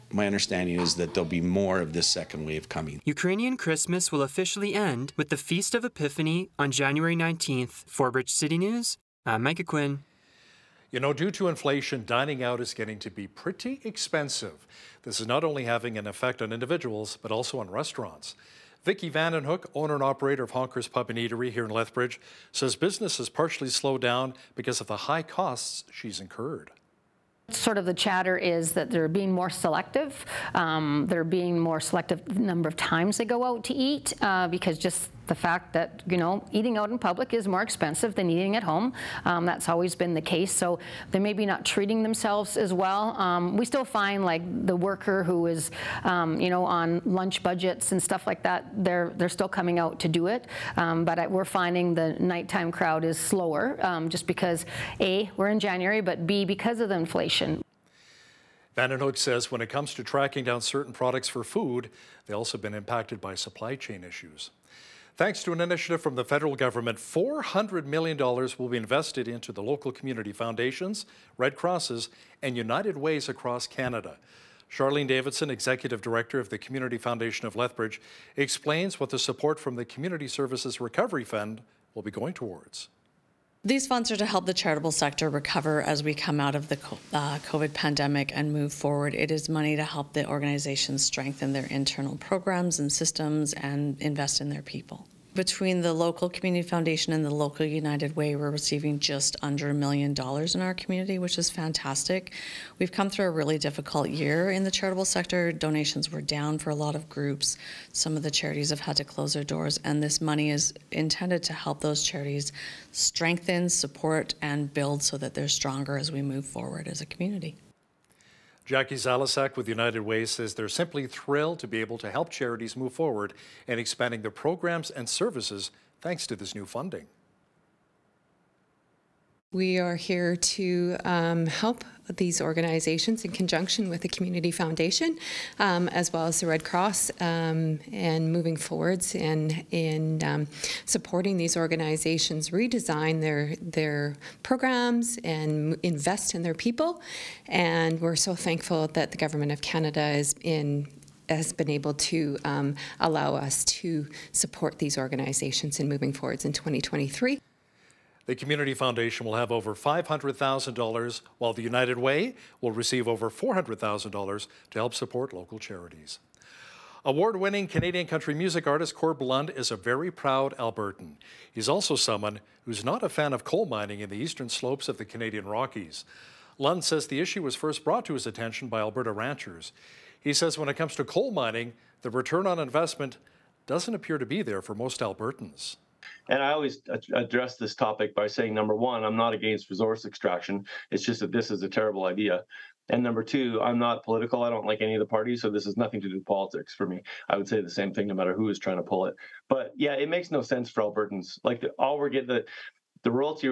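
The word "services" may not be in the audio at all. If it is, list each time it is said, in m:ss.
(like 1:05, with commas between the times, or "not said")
1:20, 2:05.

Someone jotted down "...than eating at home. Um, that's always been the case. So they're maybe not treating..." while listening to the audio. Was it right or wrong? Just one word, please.
right.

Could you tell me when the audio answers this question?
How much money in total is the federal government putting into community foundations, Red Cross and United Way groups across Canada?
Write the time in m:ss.
1:06.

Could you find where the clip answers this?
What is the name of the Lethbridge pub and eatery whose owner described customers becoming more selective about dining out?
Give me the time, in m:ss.
0:20.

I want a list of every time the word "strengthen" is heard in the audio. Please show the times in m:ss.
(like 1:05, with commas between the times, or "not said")
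1:31, 1:52.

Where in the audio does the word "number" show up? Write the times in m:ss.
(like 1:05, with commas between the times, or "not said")
0:32, 3:08, 3:13.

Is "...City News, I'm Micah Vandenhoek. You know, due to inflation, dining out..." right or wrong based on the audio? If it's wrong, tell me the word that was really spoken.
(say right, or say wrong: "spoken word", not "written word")
wrong: "Quinn", not "Vandenhoek".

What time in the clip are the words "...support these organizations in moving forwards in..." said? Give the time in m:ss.
2:34.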